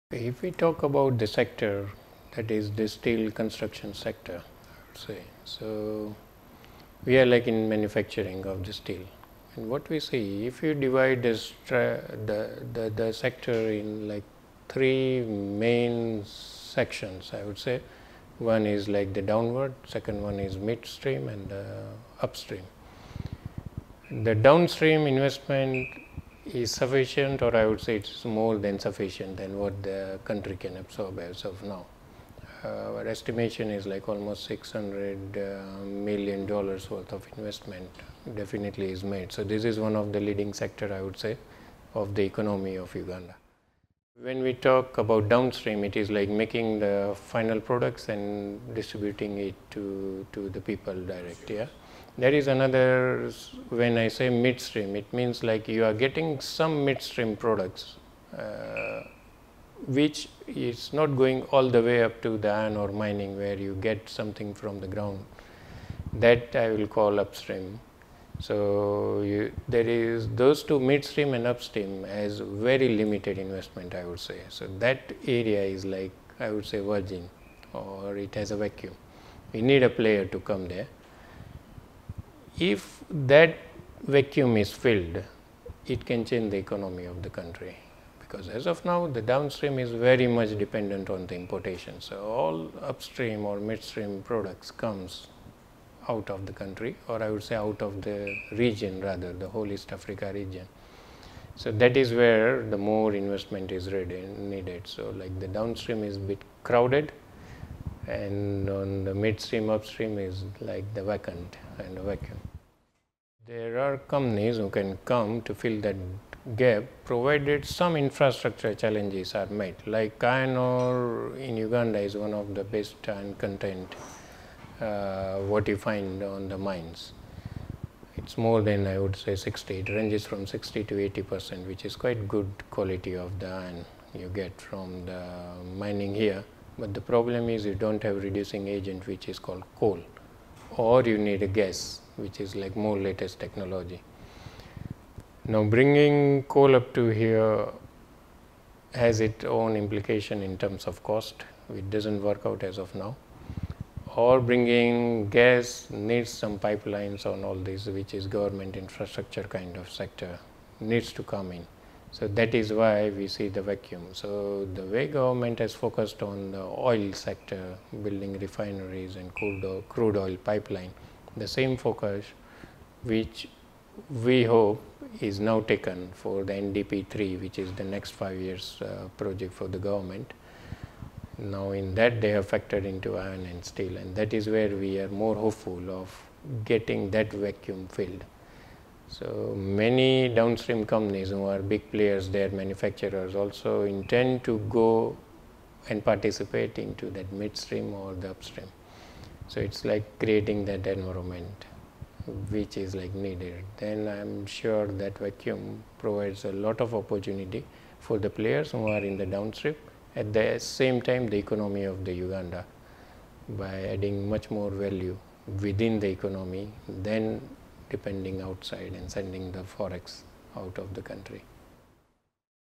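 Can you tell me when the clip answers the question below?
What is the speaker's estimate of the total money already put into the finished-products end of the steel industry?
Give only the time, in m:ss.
0:34.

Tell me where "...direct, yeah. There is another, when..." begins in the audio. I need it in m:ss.
0:50.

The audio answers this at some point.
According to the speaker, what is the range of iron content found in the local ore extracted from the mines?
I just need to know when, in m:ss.
2:10.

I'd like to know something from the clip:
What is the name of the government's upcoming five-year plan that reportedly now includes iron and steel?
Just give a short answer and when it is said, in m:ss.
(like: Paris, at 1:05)
NDP 3, at 2:56.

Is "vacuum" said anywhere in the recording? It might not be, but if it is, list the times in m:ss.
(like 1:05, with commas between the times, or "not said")
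1:18, 1:24, 1:52, 2:43, 3:07, 3:25.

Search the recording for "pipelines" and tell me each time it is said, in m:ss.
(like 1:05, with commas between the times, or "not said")
2:36, 2:50.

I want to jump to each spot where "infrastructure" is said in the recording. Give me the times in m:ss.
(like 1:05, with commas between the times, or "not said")
1:57, 2:38.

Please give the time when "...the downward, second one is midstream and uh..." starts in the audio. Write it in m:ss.
0:19.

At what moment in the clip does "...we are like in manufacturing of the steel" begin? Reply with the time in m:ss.
0:07.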